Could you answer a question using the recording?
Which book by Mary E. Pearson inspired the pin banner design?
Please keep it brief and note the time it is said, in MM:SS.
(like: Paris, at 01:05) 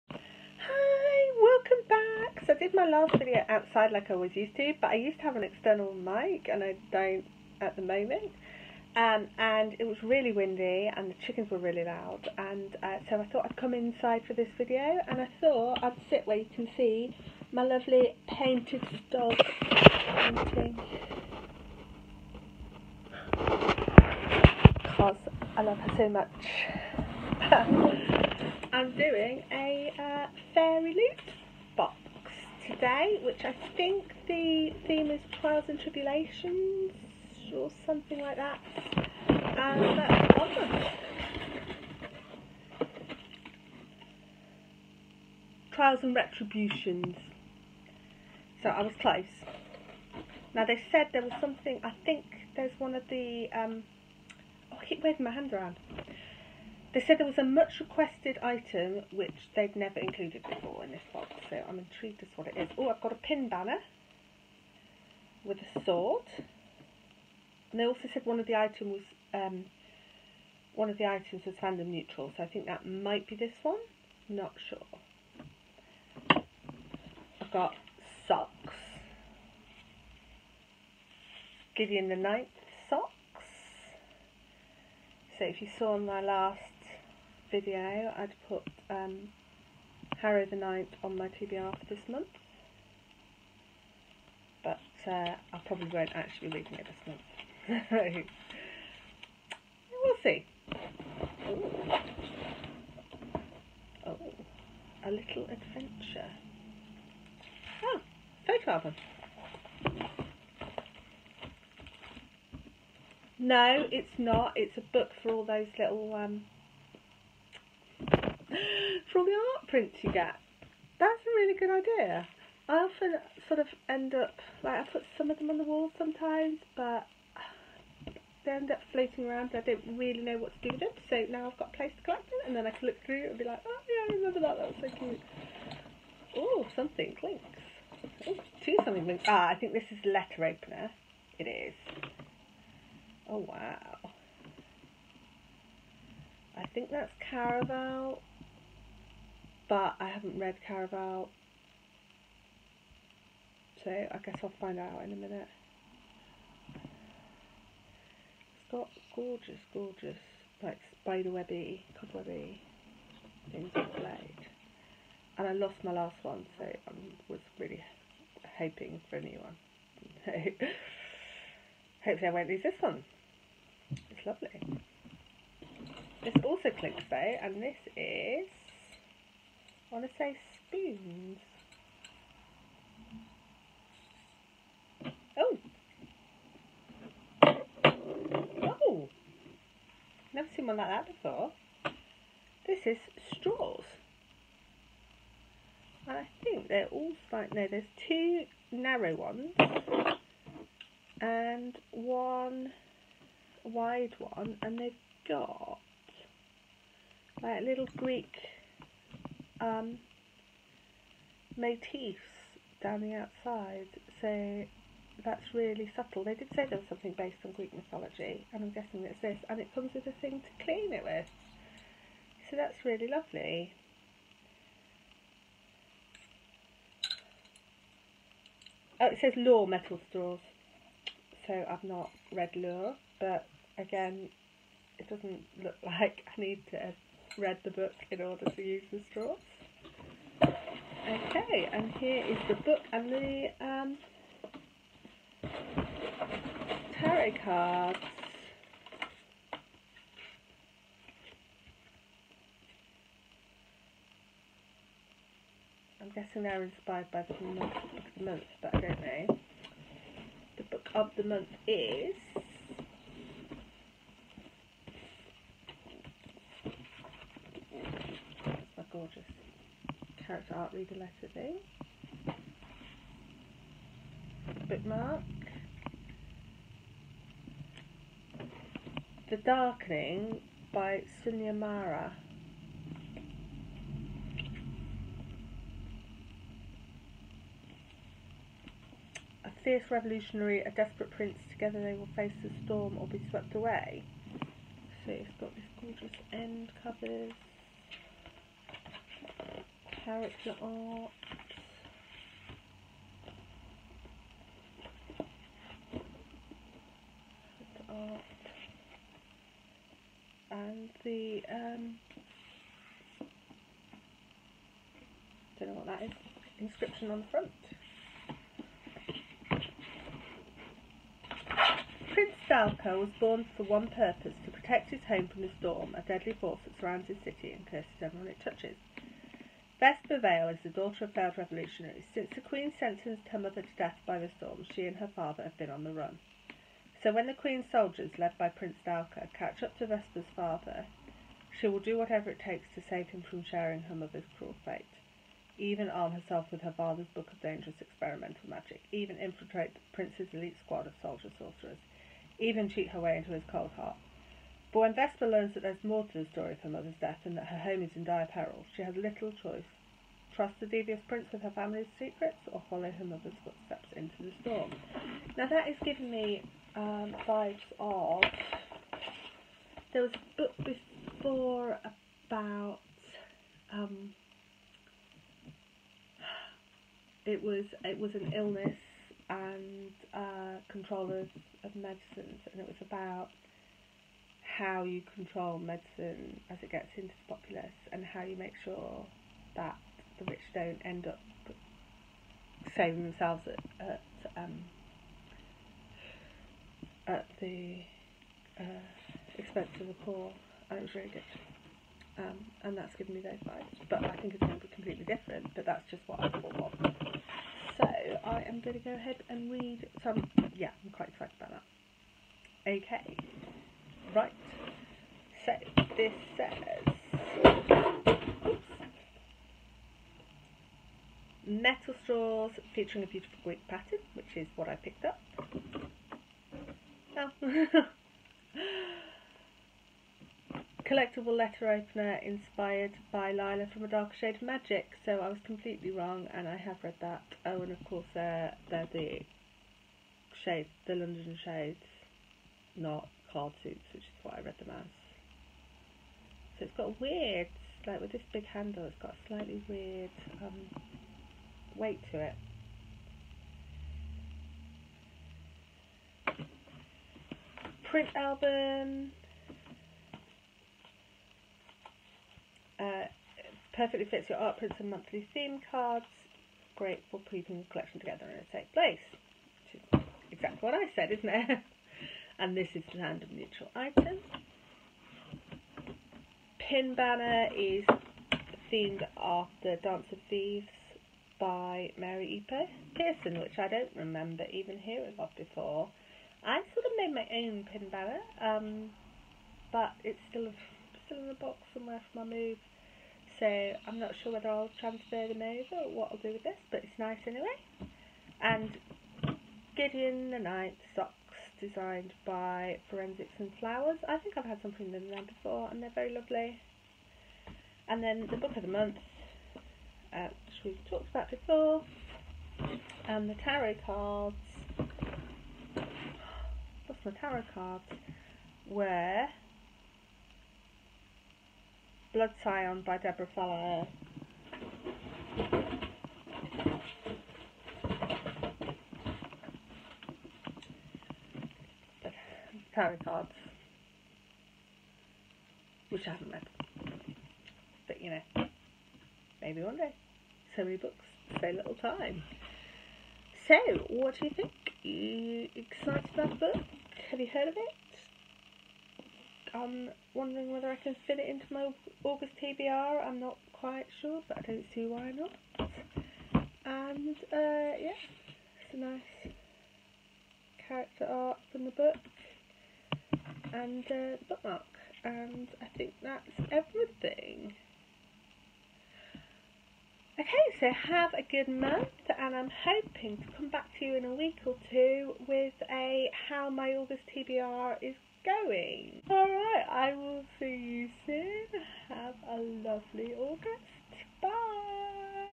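Dance of Thieves, at 07:59.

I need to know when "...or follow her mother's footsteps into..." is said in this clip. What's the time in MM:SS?
06:02.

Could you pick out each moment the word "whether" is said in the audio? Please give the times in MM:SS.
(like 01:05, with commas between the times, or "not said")
08:14, 09:10.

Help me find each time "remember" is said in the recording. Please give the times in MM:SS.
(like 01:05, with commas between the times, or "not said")
02:14, 08:03.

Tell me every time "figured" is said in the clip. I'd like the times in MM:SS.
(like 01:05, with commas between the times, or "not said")
not said.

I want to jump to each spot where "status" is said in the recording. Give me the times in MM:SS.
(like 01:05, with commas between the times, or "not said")
not said.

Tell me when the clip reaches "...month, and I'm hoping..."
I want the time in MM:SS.
09:31.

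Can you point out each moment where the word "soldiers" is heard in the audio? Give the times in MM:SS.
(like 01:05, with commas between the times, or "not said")
05:37, 05:51.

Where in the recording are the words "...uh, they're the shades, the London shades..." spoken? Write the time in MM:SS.
07:18.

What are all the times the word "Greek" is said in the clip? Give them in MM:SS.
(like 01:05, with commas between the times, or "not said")
03:27, 03:37, 07:03.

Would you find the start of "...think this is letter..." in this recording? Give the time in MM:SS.
02:19.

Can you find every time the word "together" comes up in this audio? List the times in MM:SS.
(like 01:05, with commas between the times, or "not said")
04:51, 07:47.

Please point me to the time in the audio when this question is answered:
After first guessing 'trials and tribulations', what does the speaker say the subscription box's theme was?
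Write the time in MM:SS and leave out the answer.
00:45.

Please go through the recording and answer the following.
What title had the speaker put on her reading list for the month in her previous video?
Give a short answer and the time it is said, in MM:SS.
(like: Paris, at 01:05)
Harrow the Ninth, at 01:30.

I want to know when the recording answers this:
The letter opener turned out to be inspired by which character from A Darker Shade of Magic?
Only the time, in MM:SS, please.
07:13.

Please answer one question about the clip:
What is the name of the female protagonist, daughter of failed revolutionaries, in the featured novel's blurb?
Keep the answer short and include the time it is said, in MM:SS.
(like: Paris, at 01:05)
Vesper Vale, at 05:29.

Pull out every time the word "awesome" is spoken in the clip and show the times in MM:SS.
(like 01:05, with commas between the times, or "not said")
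00:40.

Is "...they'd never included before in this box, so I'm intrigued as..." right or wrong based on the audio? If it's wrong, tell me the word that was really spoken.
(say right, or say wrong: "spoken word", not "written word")
right.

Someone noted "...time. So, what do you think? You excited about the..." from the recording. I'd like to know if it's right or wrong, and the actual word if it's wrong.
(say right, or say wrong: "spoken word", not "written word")
right.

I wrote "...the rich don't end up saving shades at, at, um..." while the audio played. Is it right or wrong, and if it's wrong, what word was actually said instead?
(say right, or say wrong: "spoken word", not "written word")
wrong: "themselves", not "shades".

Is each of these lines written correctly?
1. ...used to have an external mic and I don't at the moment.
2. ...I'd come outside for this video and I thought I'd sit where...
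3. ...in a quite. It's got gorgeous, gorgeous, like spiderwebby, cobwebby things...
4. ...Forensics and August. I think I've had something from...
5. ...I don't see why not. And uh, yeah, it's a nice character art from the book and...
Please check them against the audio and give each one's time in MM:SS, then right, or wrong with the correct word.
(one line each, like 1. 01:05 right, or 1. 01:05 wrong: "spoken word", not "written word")
1. 00:04 right
2. 00:13 wrong: "inside", not "outside"
3. 02:35 wrong: "minute", not "quite"
4. 08:22 wrong: "Flowers", not "August"
5. 09:14 right.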